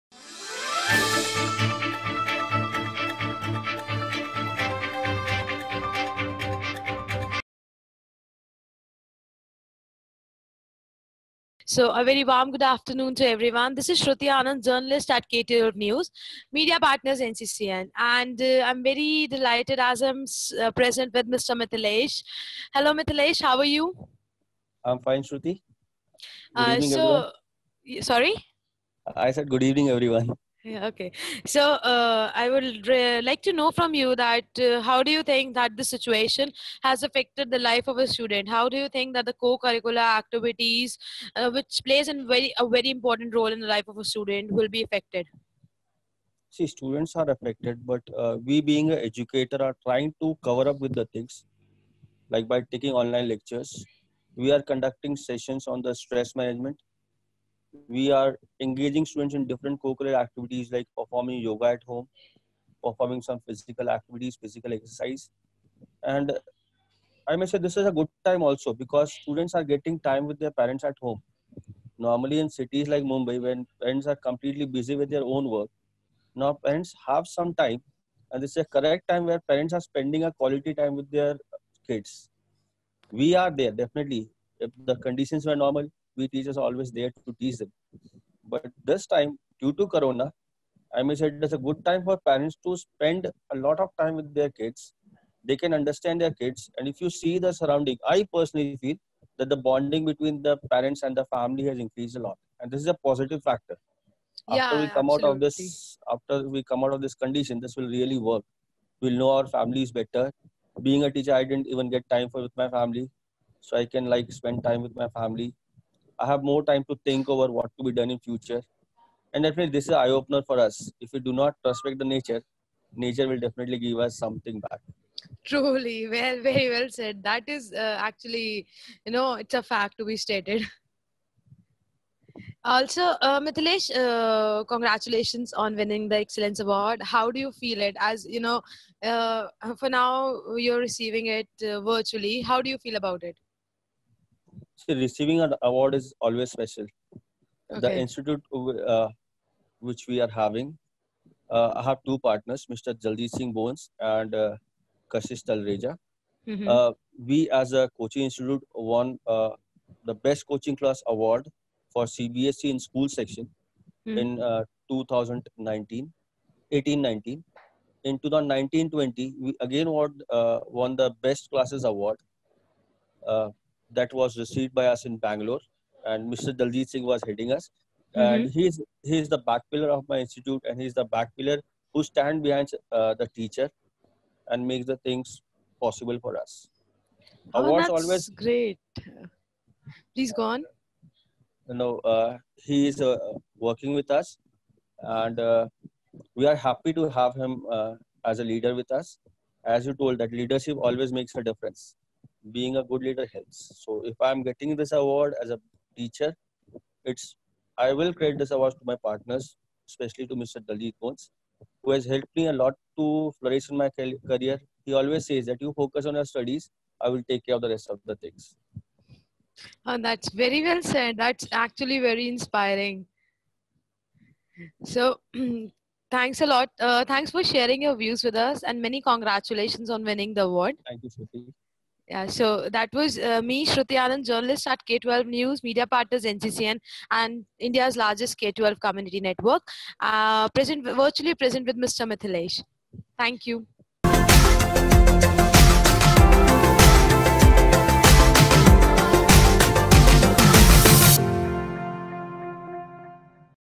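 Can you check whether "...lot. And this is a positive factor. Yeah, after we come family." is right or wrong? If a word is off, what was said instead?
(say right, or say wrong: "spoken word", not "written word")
wrong: "absolutely", not "family".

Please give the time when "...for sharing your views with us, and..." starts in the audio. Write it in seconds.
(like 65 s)
227 s.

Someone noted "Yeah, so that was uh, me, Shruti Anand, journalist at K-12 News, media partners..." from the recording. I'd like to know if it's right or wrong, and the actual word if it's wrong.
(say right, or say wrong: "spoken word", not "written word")
right.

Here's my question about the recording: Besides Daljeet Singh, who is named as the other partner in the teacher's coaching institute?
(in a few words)
Kashish Talreja.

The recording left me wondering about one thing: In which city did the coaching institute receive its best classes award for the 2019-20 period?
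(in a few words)
Bangalore.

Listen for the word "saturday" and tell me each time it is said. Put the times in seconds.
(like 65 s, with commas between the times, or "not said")
not said.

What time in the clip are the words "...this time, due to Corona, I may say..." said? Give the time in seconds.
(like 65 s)
88 s.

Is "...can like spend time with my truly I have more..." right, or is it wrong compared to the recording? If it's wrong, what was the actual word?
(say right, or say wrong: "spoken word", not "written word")
wrong: "family", not "truly".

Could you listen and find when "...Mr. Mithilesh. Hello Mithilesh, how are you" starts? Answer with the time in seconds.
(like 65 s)
21 s.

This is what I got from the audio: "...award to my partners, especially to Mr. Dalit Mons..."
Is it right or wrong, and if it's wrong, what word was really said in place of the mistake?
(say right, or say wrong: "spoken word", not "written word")
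right.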